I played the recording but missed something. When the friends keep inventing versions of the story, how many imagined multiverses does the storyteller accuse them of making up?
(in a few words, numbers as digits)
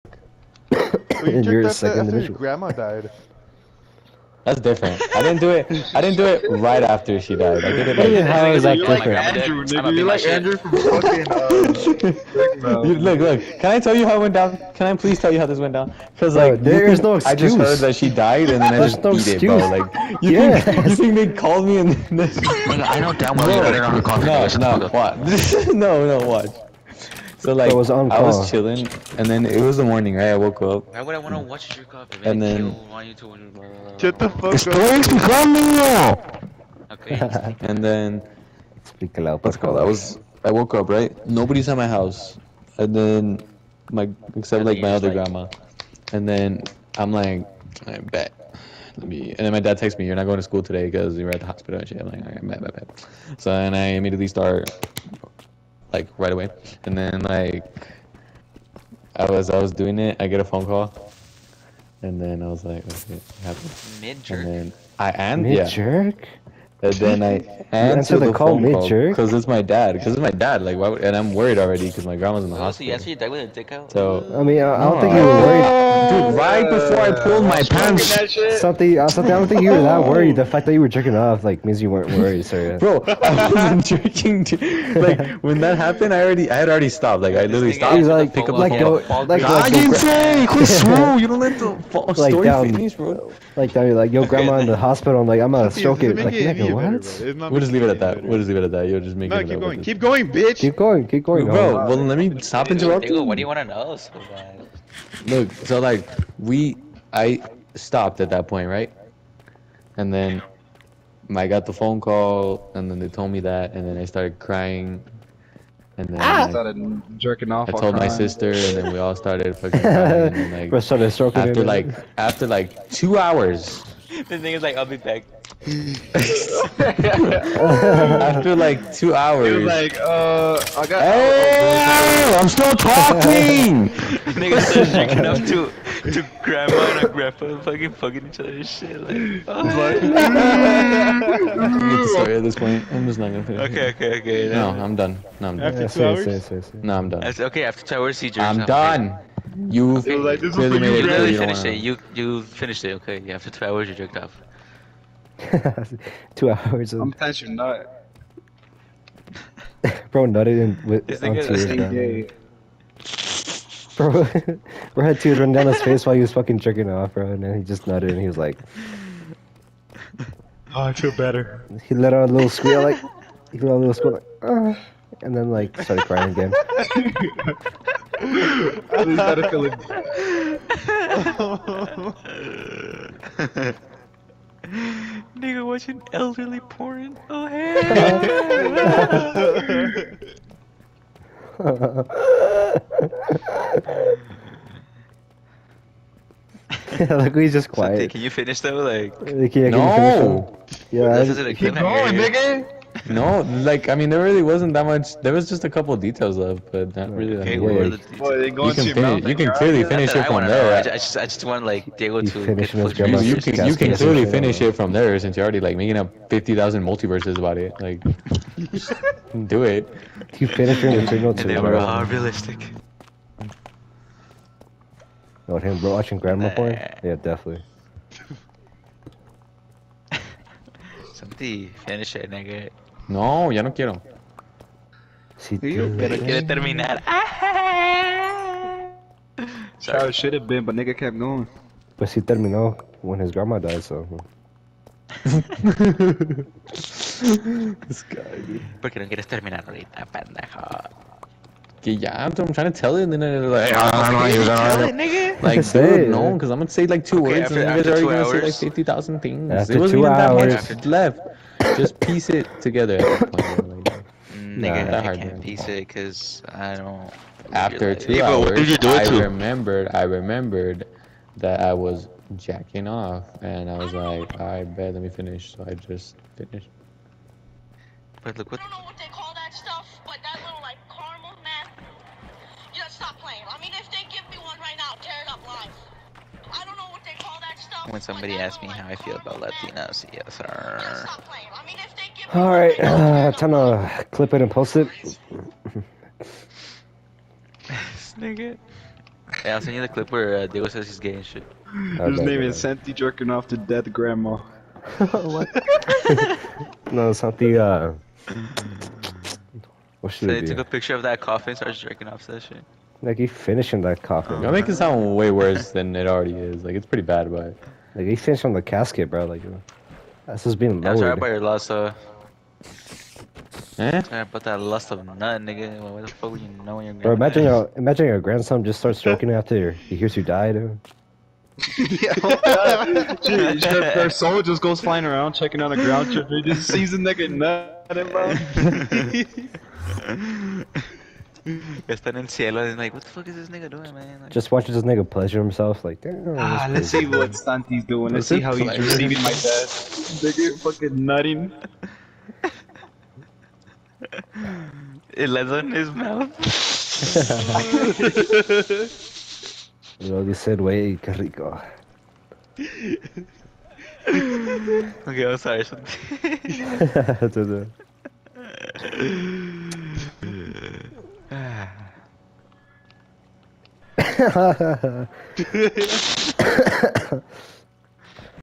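50,000.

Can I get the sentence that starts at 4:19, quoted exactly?
After it wasn't two even hours.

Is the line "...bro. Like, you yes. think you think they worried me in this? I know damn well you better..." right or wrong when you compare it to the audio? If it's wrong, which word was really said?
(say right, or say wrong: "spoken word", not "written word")
wrong: "called", not "worried".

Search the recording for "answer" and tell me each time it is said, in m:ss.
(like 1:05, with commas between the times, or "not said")
1:07, 1:13.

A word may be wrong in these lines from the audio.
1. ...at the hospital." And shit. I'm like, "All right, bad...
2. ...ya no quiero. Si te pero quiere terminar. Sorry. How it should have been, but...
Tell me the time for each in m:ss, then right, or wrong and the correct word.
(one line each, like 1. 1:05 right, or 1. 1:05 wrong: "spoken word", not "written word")
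1. 0:51 right
2. 3:53 right.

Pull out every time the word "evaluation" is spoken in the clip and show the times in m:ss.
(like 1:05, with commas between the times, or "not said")
not said.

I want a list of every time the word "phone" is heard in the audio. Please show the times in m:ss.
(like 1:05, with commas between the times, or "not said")
1:00, 1:08, 1:51.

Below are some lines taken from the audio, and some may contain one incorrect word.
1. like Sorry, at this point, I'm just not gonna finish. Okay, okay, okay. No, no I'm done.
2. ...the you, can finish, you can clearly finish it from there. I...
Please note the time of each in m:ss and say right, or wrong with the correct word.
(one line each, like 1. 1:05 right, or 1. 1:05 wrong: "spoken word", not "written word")
1. 2:19 right
2. 3:27 right.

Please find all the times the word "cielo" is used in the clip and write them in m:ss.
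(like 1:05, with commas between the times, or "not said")
5:42.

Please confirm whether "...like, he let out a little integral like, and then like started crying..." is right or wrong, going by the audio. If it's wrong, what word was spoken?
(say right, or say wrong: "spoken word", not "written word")
wrong: "squeal", not "integral".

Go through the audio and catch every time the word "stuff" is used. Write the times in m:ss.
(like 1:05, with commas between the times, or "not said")
4:39, 4:47.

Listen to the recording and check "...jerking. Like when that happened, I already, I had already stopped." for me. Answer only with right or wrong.
right.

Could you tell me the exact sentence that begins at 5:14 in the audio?
Oh, you make it sound way worse than it already is.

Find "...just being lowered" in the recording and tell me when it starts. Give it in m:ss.
5:20.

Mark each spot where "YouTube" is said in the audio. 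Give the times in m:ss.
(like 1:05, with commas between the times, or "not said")
0:33.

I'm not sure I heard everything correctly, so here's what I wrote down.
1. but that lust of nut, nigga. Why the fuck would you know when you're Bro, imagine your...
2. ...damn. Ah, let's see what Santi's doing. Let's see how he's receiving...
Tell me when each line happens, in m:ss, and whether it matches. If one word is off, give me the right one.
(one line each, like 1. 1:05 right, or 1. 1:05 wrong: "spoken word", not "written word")
1. 5:24 right
2. 5:46 right.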